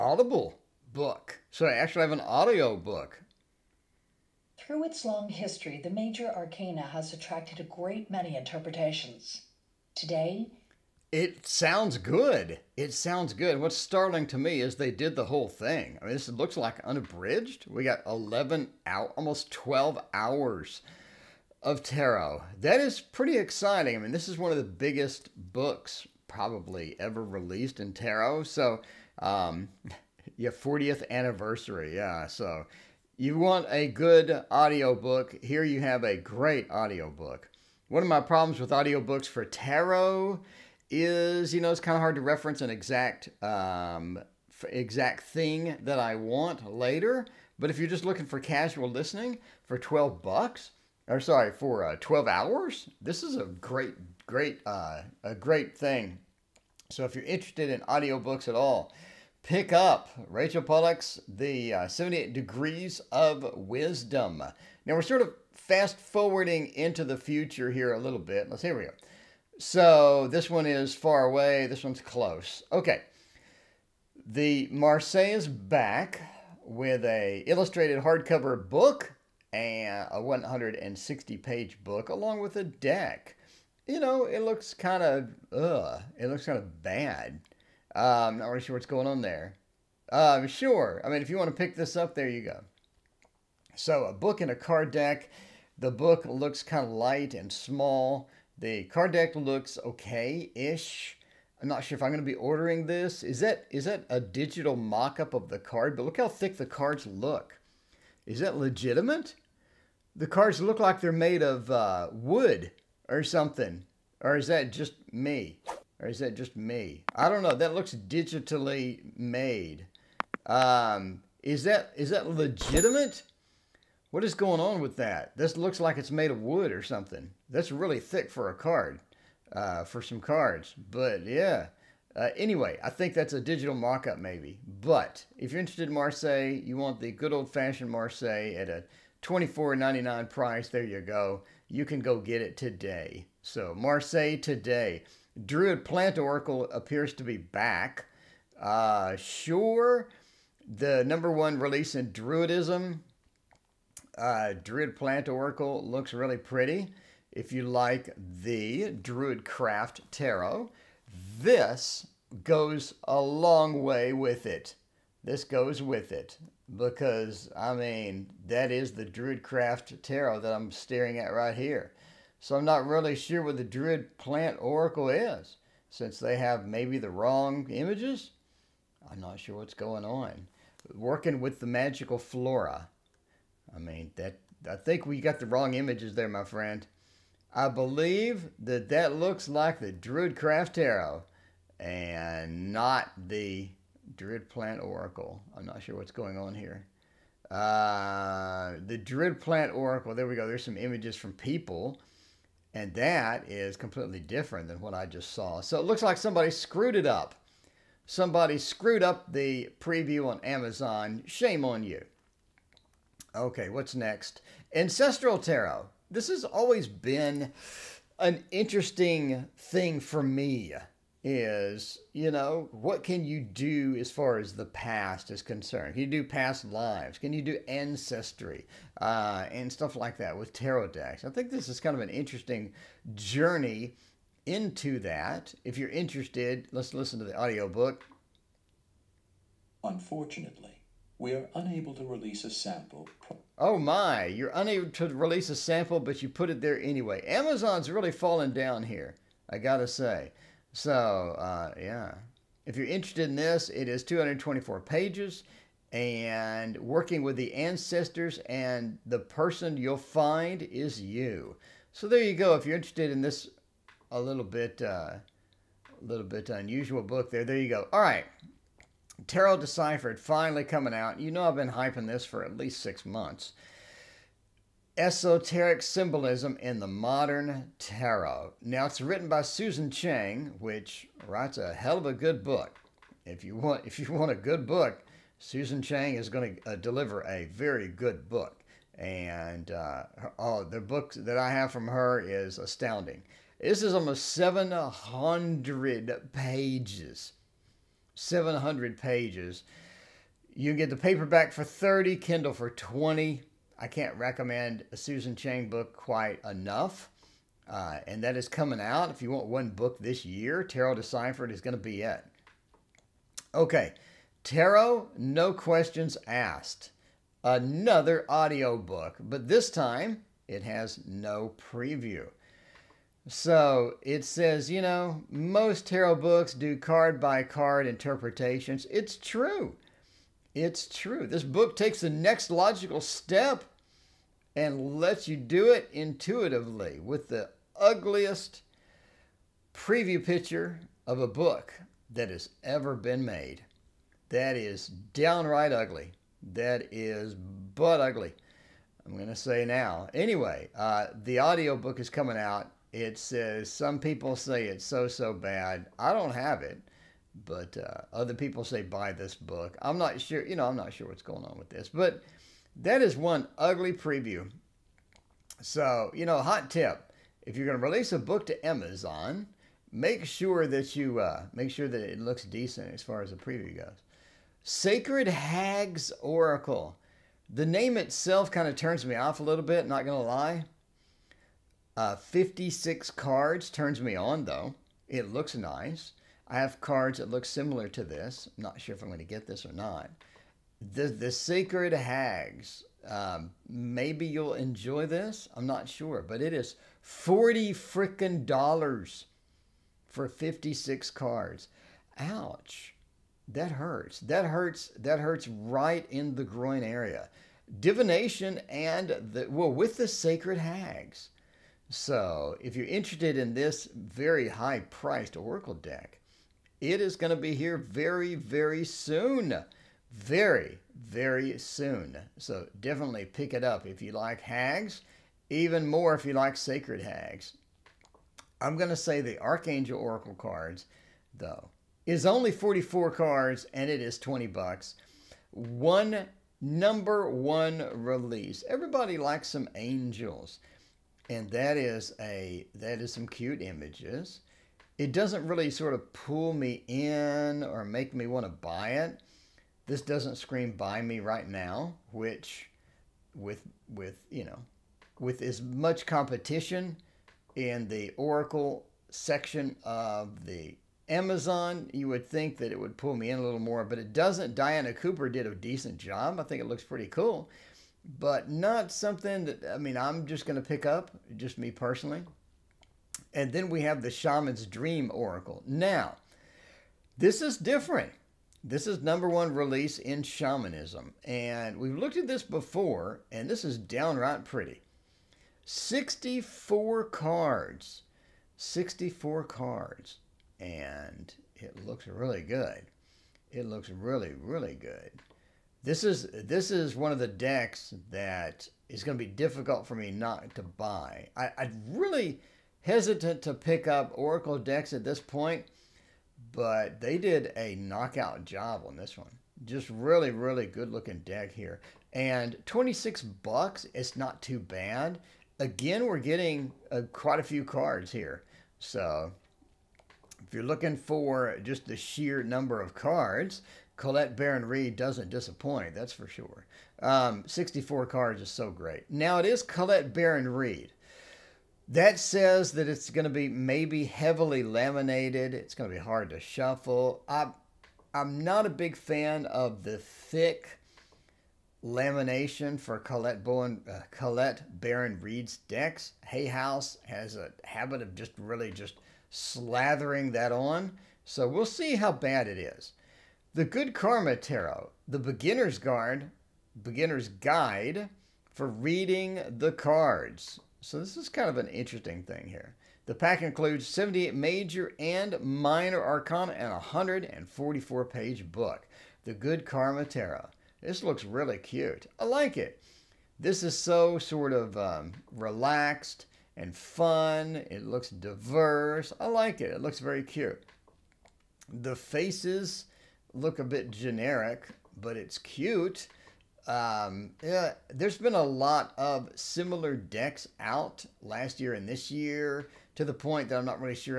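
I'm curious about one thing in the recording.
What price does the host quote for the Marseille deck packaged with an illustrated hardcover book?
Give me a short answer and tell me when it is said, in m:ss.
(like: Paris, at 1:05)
$24.99, at 2:19.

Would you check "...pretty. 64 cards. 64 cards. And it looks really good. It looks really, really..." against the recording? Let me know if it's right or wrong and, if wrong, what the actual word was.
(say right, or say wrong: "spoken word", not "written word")
right.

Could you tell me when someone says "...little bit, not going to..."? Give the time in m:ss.
6:19.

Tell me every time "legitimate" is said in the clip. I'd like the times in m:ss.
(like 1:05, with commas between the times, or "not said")
1:48, 2:02.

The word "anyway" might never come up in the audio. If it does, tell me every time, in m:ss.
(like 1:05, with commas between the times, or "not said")
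2:12, 4:06, 5:50.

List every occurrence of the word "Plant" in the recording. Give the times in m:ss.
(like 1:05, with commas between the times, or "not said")
2:25, 2:34, 2:54, 3:14, 3:19.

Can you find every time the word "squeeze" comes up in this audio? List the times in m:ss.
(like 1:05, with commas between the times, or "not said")
not said.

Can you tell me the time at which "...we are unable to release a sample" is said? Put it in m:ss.
4:01.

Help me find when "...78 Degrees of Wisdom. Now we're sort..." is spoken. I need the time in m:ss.
1:01.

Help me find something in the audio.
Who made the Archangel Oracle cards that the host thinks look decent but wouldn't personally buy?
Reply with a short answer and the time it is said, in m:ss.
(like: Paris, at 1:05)
Diana Cooper, at 7:44.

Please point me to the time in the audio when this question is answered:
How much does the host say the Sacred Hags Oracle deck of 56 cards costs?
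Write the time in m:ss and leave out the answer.
6:37.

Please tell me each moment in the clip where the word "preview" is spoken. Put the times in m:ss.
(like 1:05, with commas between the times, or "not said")
3:29, 5:21, 5:39, 6:03, 6:13.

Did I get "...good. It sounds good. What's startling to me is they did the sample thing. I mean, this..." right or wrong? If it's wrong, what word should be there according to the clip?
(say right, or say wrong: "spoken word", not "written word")
wrong: "whole", not "sample".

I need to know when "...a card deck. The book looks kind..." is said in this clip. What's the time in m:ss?
1:34.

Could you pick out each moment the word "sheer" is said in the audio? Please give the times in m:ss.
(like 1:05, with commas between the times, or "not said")
8:41.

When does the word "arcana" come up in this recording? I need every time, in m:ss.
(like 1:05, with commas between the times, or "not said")
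0:06, 9:26.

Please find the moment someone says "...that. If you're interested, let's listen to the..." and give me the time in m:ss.
3:55.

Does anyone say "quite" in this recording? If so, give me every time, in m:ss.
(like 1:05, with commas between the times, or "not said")
5:05, 8:37.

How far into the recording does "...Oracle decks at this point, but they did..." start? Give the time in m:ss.
8:24.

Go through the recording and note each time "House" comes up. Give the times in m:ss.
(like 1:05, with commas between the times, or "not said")
9:06.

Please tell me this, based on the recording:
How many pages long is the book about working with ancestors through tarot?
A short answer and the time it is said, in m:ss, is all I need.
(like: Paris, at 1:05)
224, at 4:14.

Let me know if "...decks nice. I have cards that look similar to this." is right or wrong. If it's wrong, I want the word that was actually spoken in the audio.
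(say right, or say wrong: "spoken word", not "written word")
wrong: "looks", not "decks".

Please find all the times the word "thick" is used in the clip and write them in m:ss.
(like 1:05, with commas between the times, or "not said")
1:46, 2:07, 8:59.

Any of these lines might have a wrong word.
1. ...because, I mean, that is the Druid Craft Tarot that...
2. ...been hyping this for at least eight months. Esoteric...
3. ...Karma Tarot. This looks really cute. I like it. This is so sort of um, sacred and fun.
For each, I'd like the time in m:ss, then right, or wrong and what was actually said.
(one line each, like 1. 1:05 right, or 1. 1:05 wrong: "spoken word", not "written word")
1. 2:46 right
2. 4:31 wrong: "six", not "eight"
3. 9:29 wrong: "relaxed", not "sacred".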